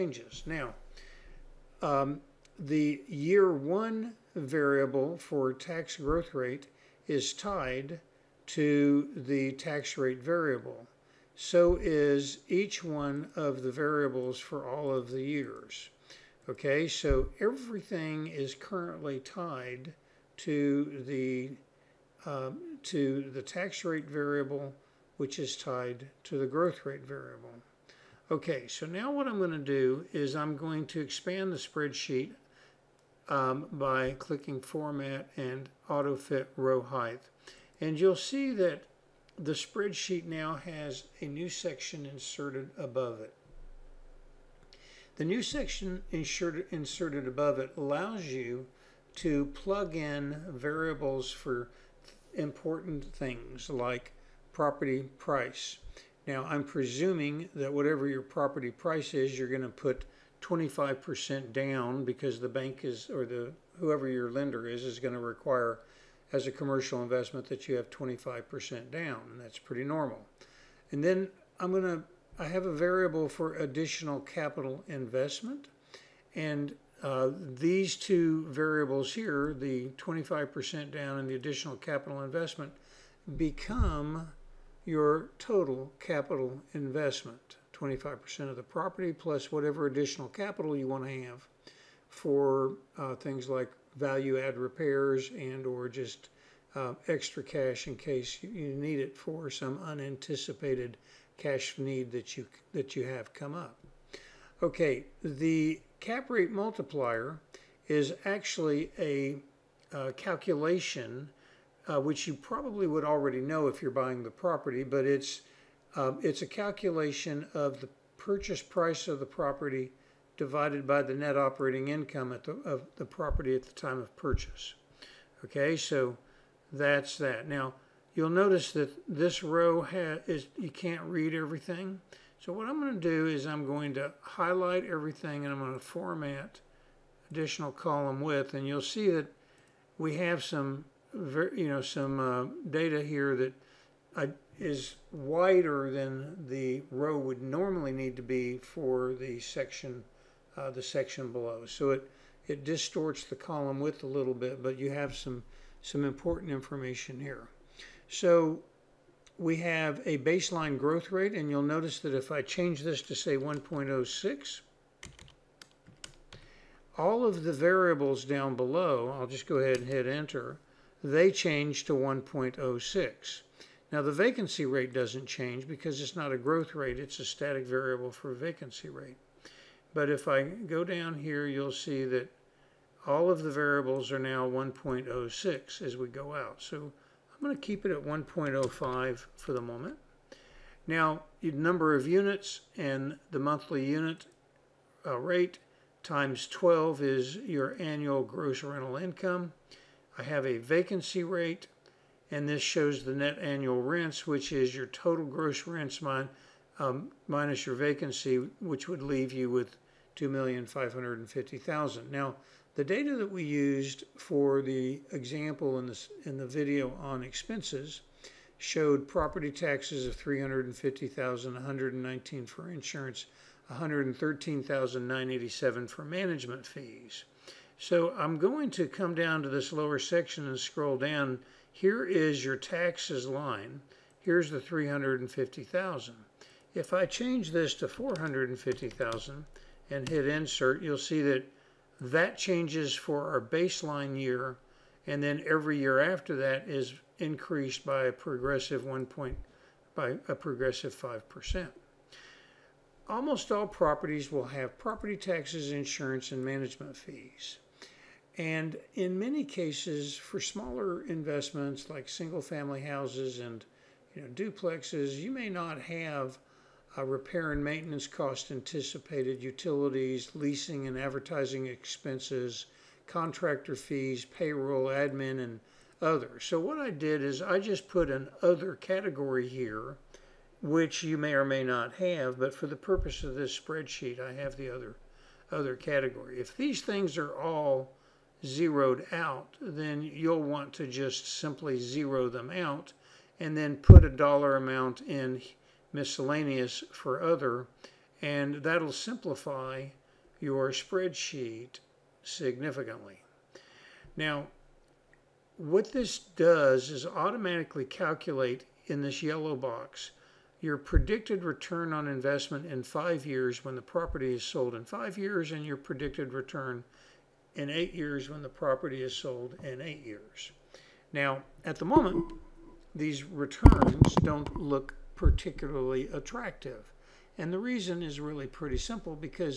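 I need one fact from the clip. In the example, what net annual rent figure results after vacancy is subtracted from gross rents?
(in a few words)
2,550,000.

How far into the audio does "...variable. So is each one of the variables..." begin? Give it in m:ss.
0:10.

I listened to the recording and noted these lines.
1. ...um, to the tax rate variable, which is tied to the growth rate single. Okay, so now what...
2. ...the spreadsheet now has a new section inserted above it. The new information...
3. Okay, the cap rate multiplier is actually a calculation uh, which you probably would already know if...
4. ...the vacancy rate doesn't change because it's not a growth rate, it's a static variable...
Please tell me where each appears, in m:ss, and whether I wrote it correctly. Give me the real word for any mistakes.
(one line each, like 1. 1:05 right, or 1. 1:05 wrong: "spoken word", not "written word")
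1. 0:22 wrong: "variable", not "single"
2. 0:39 wrong: "section", not "information"
3. 1:44 right
4. 2:54 right.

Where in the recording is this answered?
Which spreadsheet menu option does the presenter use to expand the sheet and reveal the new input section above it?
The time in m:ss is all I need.
0:35.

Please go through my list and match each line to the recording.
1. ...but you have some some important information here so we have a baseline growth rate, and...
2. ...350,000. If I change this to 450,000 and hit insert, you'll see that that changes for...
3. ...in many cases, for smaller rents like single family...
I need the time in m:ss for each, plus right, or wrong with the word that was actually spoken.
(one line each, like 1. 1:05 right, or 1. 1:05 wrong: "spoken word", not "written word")
1. 2:34 right
2. 3:54 right
3. 4:18 wrong: "investments", not "rents".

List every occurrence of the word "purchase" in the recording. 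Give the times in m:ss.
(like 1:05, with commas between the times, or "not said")
1:58, 2:04.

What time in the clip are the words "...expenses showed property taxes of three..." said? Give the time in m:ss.
3:37.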